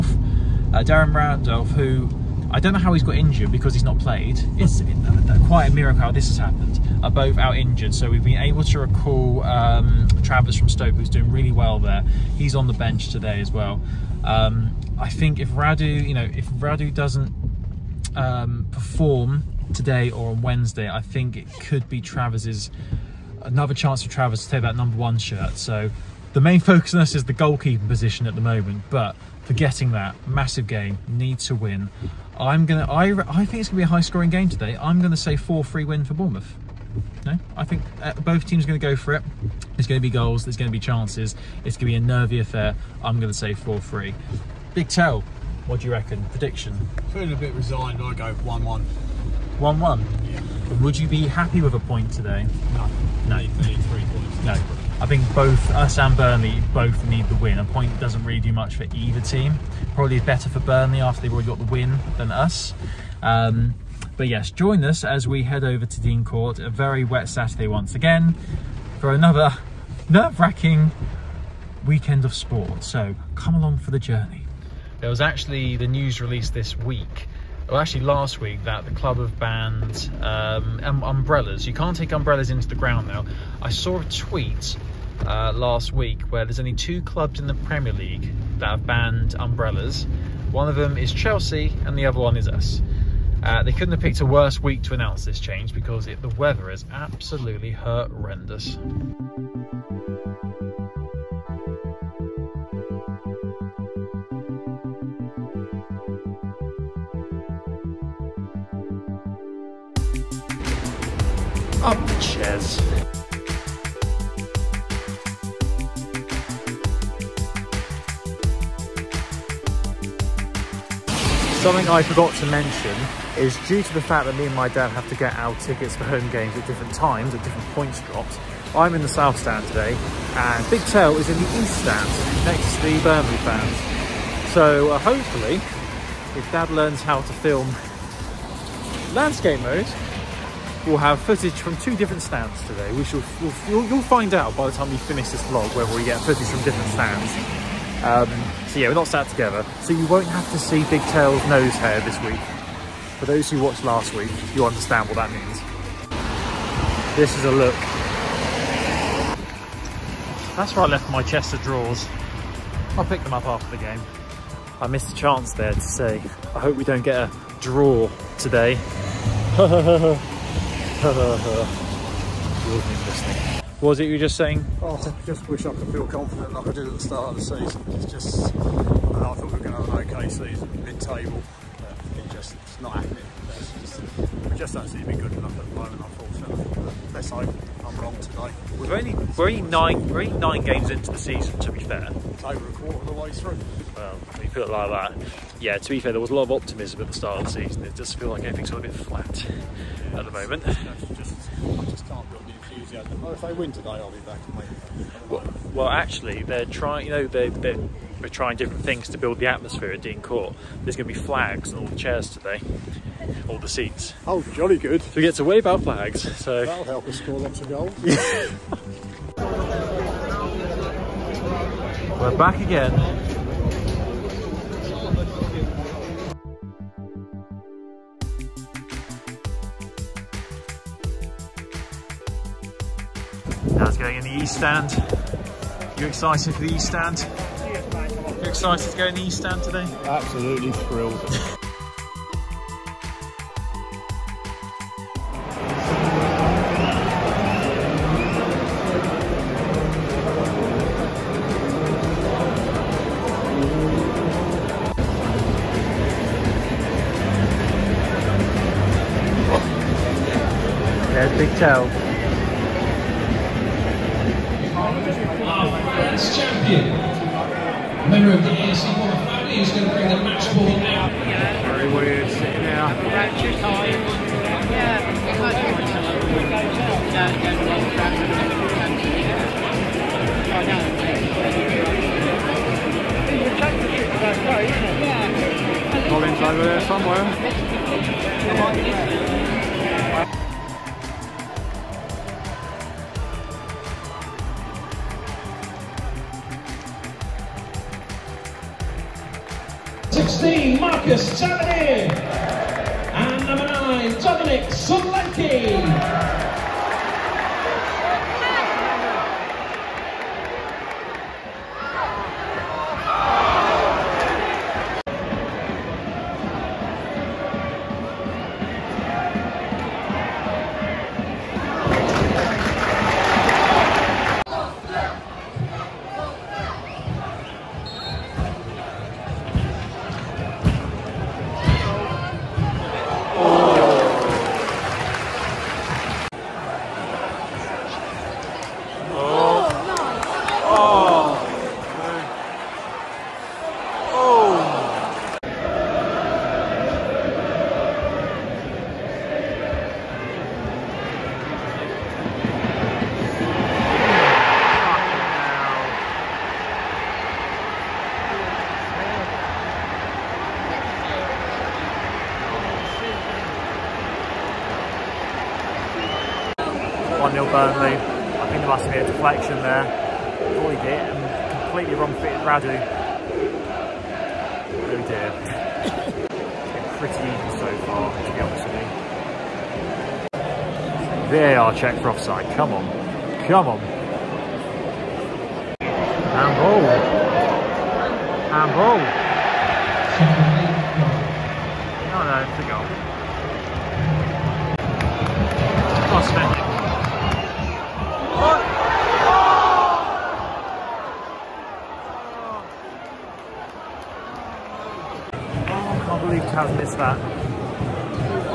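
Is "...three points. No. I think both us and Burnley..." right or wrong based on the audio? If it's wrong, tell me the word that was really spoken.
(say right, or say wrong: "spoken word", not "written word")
right.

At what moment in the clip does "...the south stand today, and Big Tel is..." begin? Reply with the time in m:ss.
2:09.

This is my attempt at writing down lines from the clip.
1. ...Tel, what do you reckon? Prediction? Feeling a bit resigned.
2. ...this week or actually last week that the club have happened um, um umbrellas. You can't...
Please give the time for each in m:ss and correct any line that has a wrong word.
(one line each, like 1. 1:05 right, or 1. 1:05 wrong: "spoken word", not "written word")
1. 0:44 right
2. 1:16 wrong: "banned", not "happened".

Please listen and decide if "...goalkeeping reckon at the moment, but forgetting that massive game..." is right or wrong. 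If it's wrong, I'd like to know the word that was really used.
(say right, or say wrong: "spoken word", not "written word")
wrong: "position", not "reckon".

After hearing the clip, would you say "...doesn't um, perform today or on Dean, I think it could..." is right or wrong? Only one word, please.
wrong.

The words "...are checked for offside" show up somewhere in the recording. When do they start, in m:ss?
6:21.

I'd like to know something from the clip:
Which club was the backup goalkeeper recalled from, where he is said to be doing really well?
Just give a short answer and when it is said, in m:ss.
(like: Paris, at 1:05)
Stoke, at 0:10.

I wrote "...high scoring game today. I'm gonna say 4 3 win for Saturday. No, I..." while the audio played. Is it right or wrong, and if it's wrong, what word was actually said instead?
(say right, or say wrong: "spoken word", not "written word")
wrong: "Bournemouth", not "Saturday".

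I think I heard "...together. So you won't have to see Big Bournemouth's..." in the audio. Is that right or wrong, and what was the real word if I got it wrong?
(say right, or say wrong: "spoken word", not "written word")
wrong: "Tel", not "Bournemouth".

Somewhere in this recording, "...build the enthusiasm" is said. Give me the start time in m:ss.
3:22.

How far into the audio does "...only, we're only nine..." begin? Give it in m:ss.
3:08.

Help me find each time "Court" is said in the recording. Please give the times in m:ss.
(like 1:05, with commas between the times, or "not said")
1:06, 3:30.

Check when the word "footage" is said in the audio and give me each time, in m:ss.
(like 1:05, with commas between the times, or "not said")
2:21, 2:26.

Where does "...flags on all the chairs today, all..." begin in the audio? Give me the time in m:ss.
3:31.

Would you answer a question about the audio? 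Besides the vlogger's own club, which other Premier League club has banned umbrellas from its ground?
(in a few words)
Chelsea.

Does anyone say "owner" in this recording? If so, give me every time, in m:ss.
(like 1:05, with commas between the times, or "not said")
not said.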